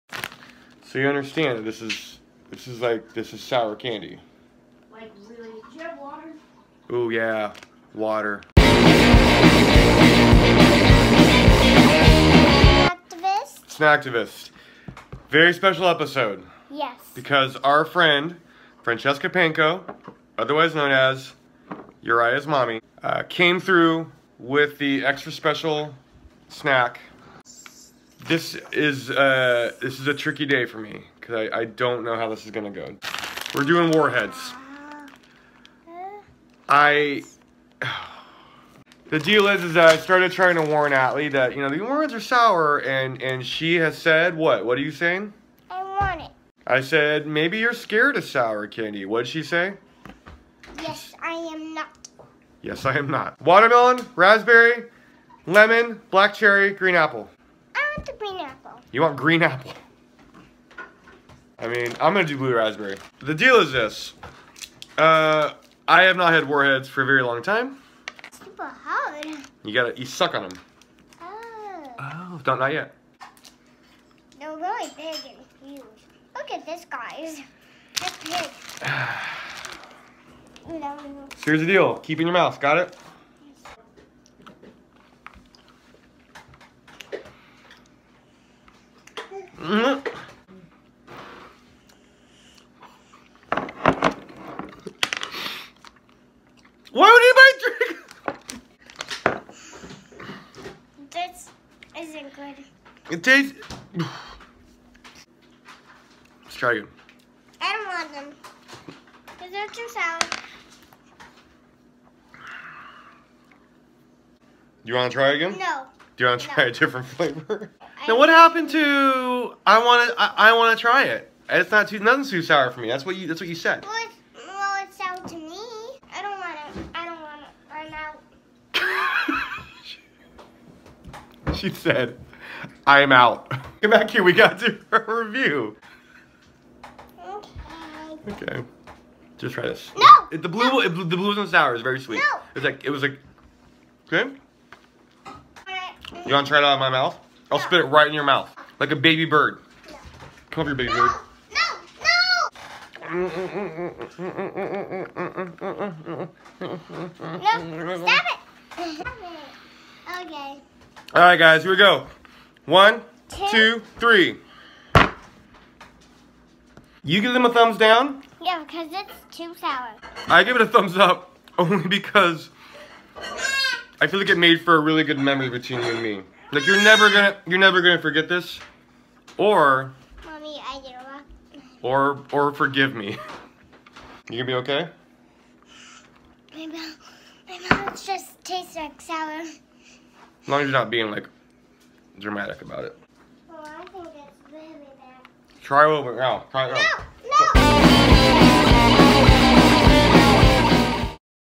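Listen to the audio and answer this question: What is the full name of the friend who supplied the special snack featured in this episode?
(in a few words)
Francesca Panko.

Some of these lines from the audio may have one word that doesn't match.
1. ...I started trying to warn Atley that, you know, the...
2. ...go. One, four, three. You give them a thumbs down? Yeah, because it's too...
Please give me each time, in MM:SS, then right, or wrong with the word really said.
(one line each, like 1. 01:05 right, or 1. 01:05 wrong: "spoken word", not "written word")
1. 00:39 right
2. 02:41 wrong: "two", not "four".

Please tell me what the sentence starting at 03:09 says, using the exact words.
As long as you're not being like dramatic about it.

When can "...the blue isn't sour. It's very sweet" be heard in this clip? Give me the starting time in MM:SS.
02:20.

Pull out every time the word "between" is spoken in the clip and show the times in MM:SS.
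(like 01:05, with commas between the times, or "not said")
02:55.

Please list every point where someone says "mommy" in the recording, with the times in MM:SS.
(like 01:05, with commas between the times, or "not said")
00:22, 03:00.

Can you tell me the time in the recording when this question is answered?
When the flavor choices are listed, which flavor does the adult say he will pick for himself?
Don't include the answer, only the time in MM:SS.
01:02.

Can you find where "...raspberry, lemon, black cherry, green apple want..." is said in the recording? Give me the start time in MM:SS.
00:54.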